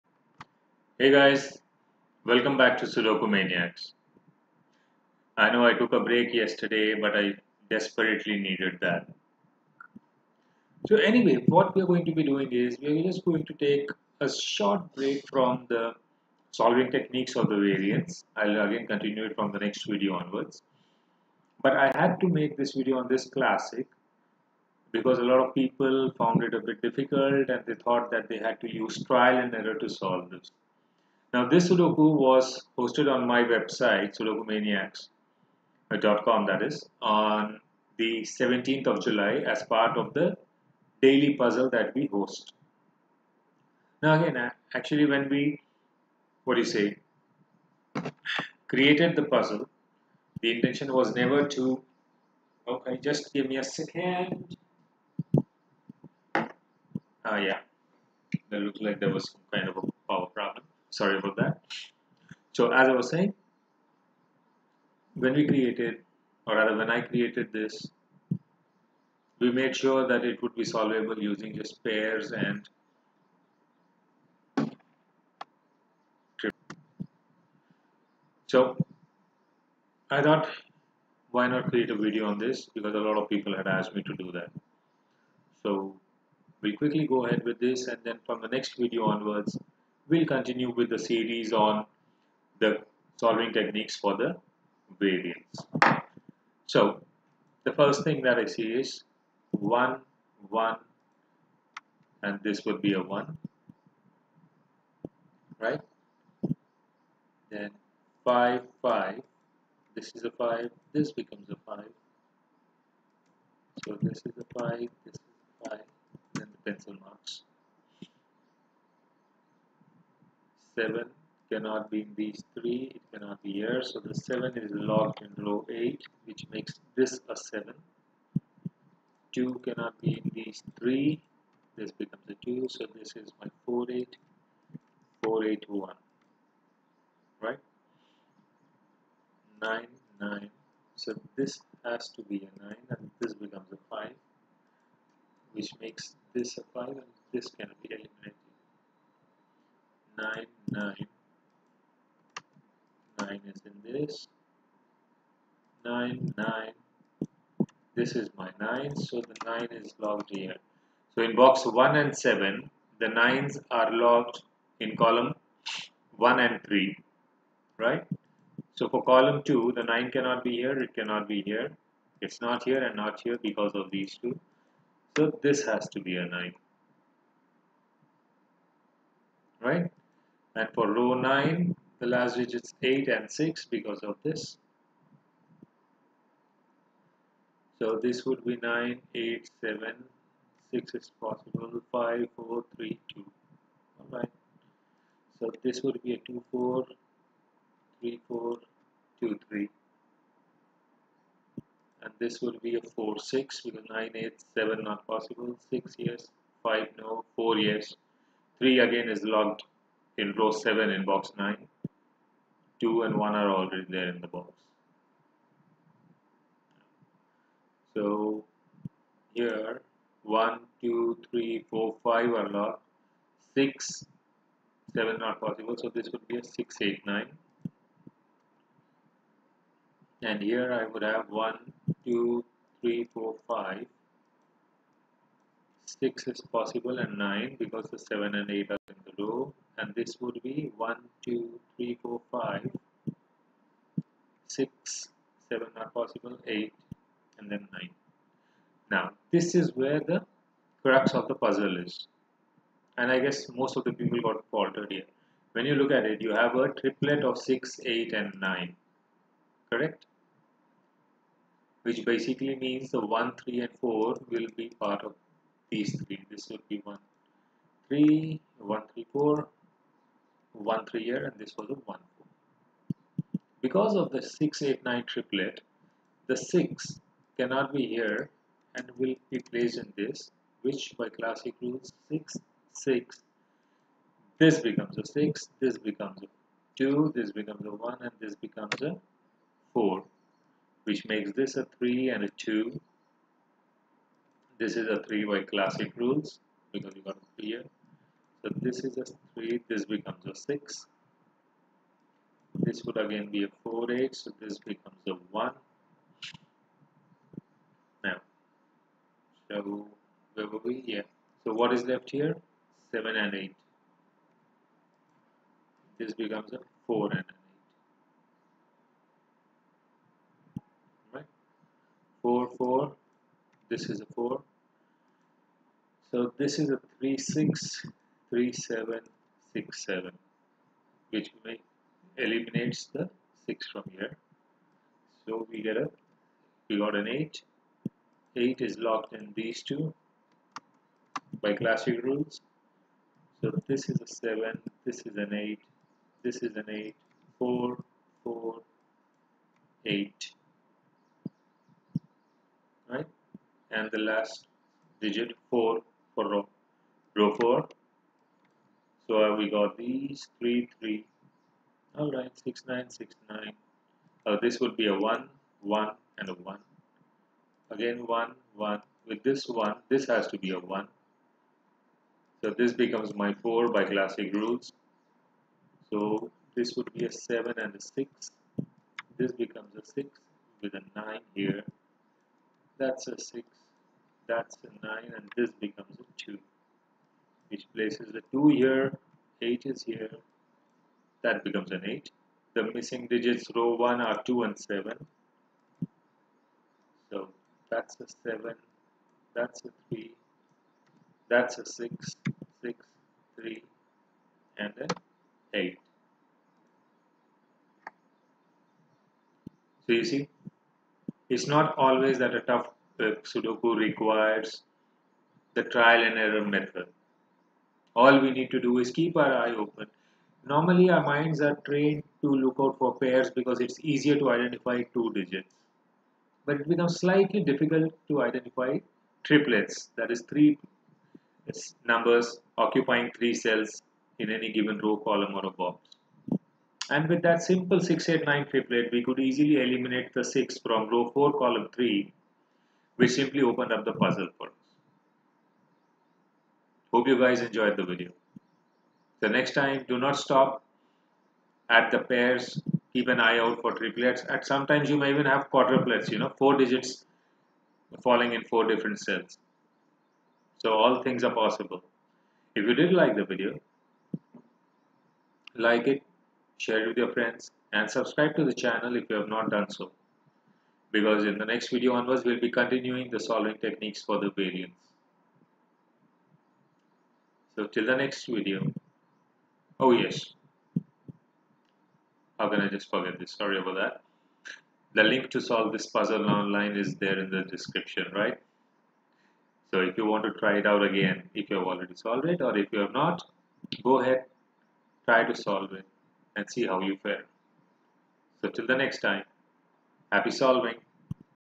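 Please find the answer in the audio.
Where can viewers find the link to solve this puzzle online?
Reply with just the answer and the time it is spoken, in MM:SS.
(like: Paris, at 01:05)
the description, at 08:07.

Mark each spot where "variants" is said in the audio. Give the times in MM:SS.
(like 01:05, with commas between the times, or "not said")
00:17, 01:34, 07:54.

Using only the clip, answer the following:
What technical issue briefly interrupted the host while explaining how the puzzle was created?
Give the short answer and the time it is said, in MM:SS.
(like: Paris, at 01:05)
power problem, at 01:00.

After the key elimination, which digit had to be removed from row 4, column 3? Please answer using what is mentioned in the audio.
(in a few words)
6.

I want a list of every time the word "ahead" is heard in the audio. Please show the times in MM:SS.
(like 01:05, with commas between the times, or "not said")
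01:27, 08:14.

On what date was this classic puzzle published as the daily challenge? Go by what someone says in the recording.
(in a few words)
17th of July.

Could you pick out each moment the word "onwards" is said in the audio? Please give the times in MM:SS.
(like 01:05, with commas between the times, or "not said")
00:20, 01:29, 07:51.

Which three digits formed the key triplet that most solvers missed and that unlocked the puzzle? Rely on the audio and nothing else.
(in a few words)
6, 8 and 9.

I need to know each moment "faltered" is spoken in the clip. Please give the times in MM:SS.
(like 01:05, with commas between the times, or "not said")
04:14.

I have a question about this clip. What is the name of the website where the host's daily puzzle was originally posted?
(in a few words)
sudokumaniacs.com.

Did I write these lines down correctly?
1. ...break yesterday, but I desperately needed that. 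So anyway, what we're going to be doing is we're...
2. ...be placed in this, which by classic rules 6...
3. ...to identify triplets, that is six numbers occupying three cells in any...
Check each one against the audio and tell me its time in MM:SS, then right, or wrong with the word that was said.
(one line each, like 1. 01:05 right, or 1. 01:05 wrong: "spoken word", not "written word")
1. 00:06 right
2. 04:39 right
3. 07:08 wrong: "three", not "six".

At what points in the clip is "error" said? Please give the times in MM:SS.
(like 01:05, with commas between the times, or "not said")
00:29, 06:56.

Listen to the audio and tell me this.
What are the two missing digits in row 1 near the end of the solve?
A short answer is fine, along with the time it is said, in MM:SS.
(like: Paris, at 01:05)
2 and 7, at 06:34.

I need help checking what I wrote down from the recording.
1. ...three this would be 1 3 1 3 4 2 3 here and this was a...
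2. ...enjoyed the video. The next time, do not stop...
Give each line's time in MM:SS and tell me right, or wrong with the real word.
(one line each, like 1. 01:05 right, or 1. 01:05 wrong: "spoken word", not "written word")
1. 04:25 wrong: "1", not "2"
2. 07:27 right.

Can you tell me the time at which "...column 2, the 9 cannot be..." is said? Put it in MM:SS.
02:49.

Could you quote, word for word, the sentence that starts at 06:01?
All right, six, nine, six, nine.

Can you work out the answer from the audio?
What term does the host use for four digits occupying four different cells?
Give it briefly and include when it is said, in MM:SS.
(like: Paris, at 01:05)
quadruplets, at 07:35.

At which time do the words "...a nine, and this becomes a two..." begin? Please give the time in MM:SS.
06:24.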